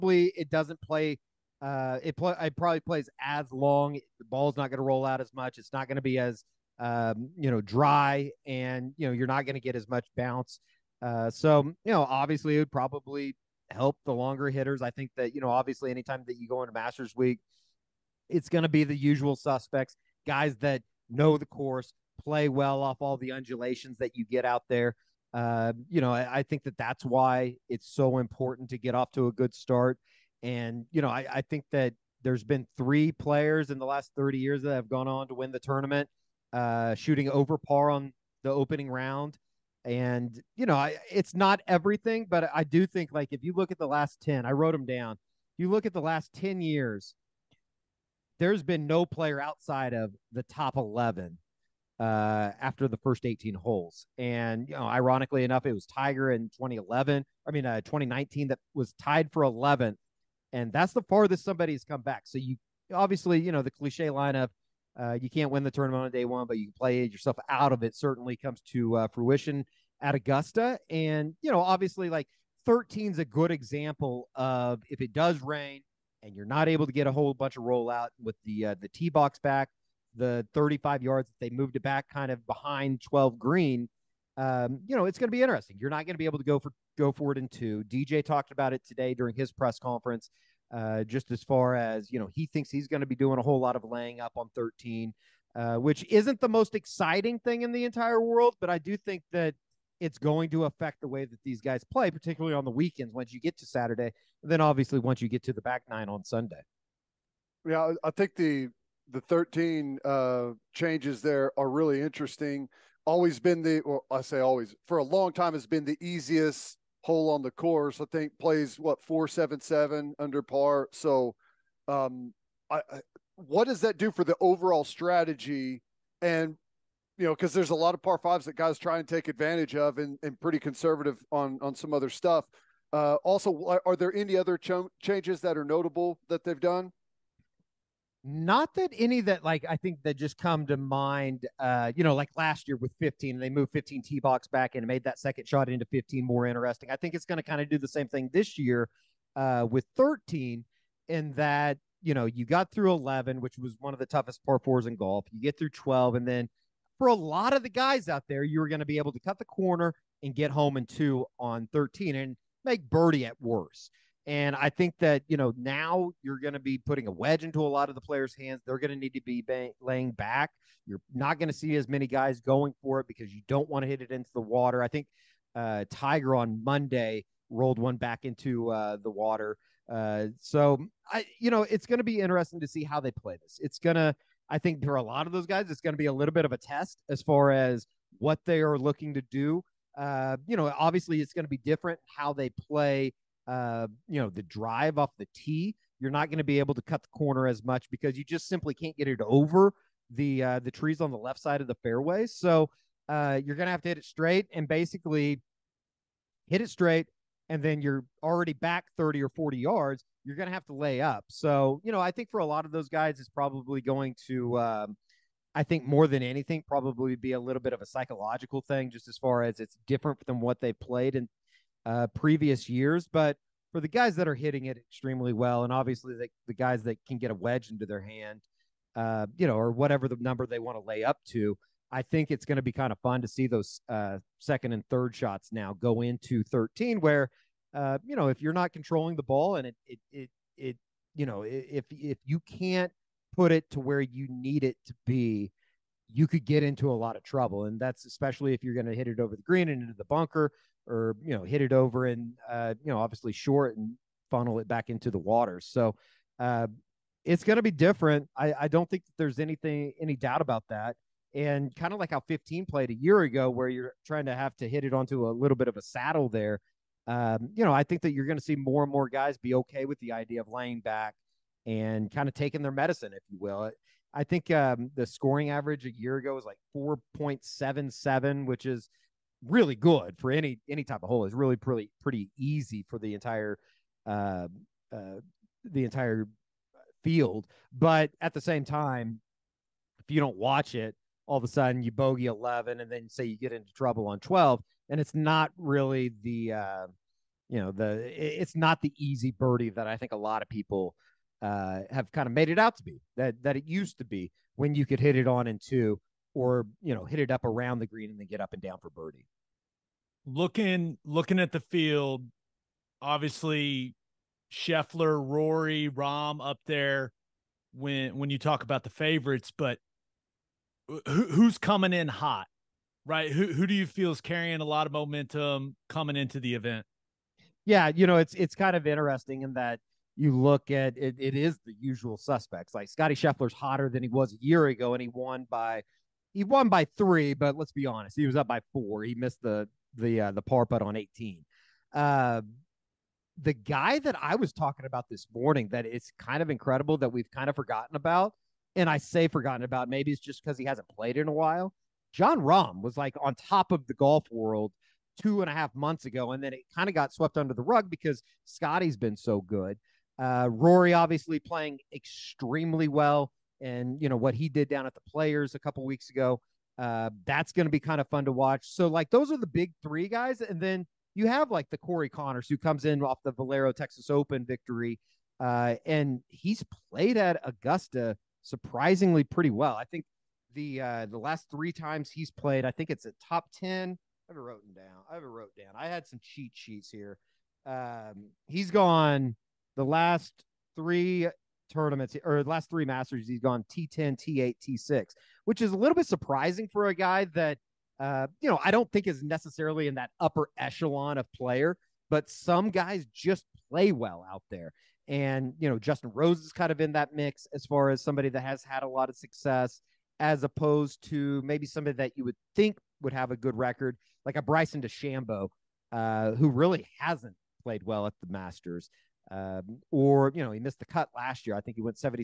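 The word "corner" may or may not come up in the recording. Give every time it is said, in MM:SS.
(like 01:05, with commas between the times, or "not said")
02:39, 03:17.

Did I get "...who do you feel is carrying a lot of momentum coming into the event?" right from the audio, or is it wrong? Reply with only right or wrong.
right.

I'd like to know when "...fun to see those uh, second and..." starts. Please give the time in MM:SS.
03:52.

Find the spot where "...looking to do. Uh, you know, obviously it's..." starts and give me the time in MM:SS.
03:08.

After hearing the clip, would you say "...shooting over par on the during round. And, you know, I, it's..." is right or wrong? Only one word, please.
wrong.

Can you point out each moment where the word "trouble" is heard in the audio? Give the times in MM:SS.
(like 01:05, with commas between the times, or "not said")
04:07, 04:53.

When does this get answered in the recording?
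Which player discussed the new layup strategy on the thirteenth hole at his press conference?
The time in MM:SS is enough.
01:27.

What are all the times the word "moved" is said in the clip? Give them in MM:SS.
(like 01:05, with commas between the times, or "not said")
01:21, 02:23.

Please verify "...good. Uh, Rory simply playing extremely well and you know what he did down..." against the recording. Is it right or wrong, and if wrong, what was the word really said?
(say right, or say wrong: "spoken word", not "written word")
wrong: "obviously", not "simply".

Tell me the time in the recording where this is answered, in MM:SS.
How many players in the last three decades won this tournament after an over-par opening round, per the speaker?
00:32.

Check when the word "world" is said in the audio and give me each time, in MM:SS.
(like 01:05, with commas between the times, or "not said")
01:38, 05:54.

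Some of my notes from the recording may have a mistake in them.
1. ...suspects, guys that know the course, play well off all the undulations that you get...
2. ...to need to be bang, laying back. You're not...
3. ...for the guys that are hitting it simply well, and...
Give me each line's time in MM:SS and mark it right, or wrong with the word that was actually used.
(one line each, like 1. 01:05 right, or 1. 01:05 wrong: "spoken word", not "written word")
1. 00:19 right
2. 02:48 right
3. 03:43 wrong: "extremely", not "simply".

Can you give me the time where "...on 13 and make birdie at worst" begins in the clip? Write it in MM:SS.
02:41.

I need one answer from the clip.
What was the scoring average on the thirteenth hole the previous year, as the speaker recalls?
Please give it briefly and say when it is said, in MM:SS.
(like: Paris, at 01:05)
4.77, at 04:36.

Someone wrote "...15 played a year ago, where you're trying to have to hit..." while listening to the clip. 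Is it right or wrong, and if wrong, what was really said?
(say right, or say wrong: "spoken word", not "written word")
right.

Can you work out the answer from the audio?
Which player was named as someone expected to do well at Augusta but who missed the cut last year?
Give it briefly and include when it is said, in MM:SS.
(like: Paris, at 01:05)
Bryson DeChambeau, at 06:54.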